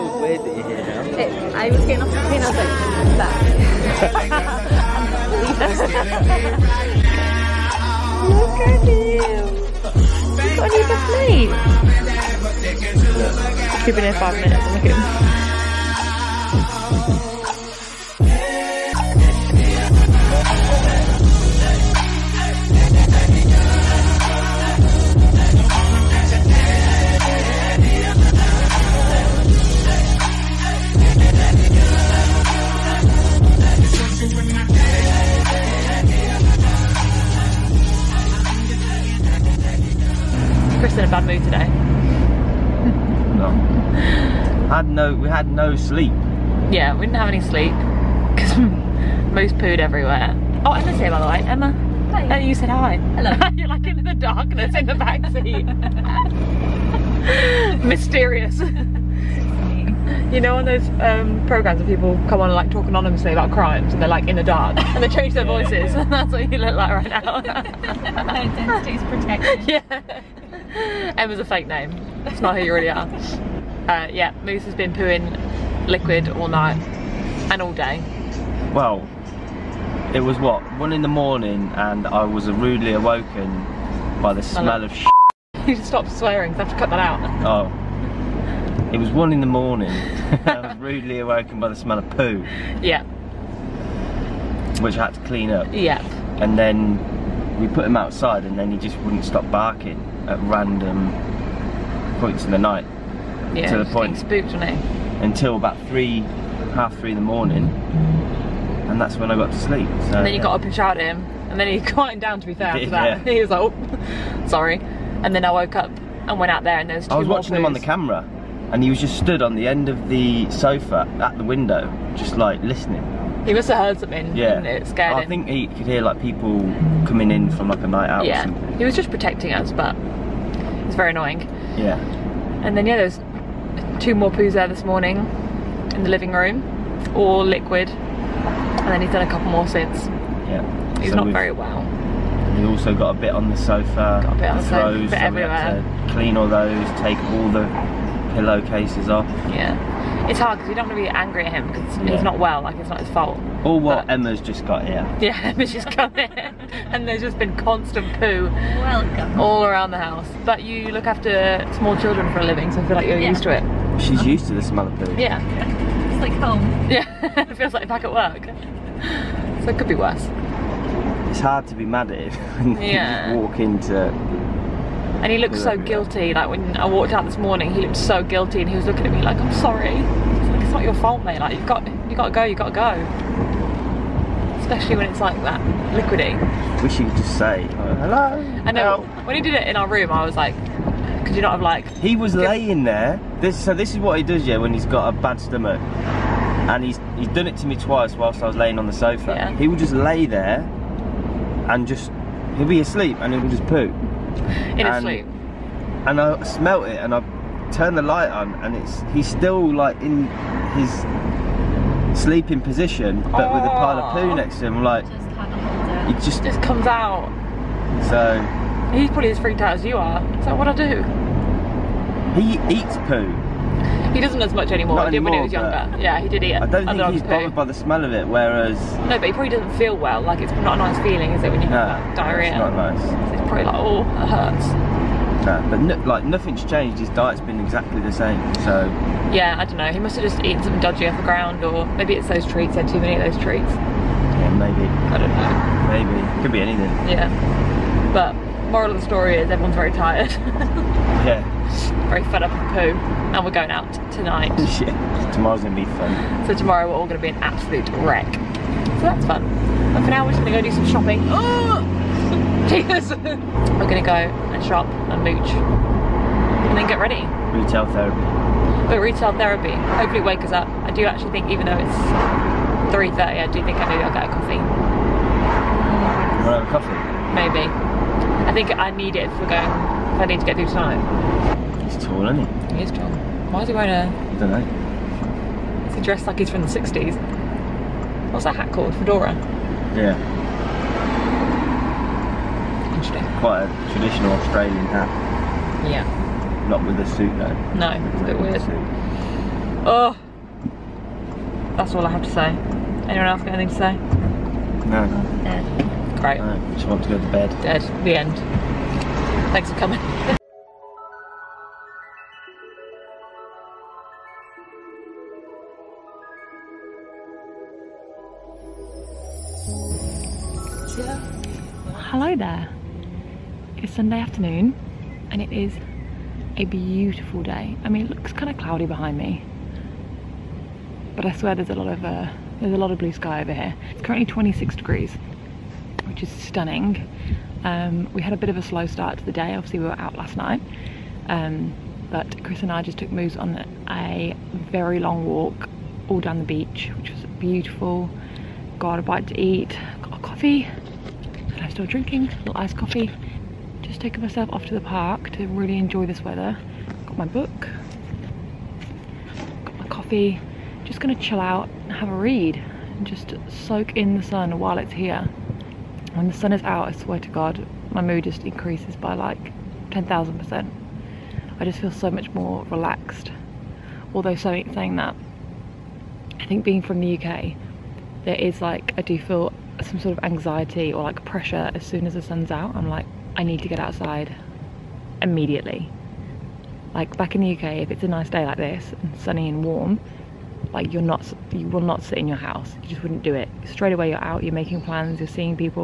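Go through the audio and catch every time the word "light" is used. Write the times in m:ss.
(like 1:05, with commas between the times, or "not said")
3:28.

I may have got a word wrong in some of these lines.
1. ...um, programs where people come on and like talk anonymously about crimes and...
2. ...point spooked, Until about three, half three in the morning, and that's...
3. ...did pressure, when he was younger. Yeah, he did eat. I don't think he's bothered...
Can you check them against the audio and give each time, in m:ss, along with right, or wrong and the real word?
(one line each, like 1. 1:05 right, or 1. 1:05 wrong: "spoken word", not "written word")
1. 1:00 right
2. 1:43 right
3. 3:45 wrong: "anymore", not "pressure".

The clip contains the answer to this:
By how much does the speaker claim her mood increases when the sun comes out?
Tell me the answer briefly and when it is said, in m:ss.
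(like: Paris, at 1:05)
10,000%, at 6:09.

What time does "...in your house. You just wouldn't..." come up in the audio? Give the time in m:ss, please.
6:32.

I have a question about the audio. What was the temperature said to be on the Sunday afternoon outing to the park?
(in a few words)
26 degrees.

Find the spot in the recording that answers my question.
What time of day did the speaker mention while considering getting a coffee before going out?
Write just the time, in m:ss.
4:32.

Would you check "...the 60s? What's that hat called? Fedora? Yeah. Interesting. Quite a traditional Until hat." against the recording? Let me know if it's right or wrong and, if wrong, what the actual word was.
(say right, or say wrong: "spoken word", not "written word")
wrong: "Australian", not "Until".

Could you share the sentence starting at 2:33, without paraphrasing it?
Or what but Emma's just got here.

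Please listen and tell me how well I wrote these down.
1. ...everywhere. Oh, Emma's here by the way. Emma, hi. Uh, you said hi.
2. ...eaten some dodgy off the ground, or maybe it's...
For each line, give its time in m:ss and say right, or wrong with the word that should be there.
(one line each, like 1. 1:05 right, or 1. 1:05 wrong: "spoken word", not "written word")
1. 0:49 right
2. 4:00 right.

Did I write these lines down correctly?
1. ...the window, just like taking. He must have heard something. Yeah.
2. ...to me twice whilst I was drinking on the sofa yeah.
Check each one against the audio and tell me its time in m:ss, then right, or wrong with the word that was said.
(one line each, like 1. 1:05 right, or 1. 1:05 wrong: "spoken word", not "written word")
1. 2:01 wrong: "listening", not "taking"
2. 3:17 wrong: "laying", not "drinking".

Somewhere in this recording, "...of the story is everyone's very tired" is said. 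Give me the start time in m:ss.
4:08.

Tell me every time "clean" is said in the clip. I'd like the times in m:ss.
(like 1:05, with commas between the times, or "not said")
1:35, 2:26.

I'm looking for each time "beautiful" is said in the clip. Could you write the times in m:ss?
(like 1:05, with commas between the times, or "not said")
5:26, 5:47.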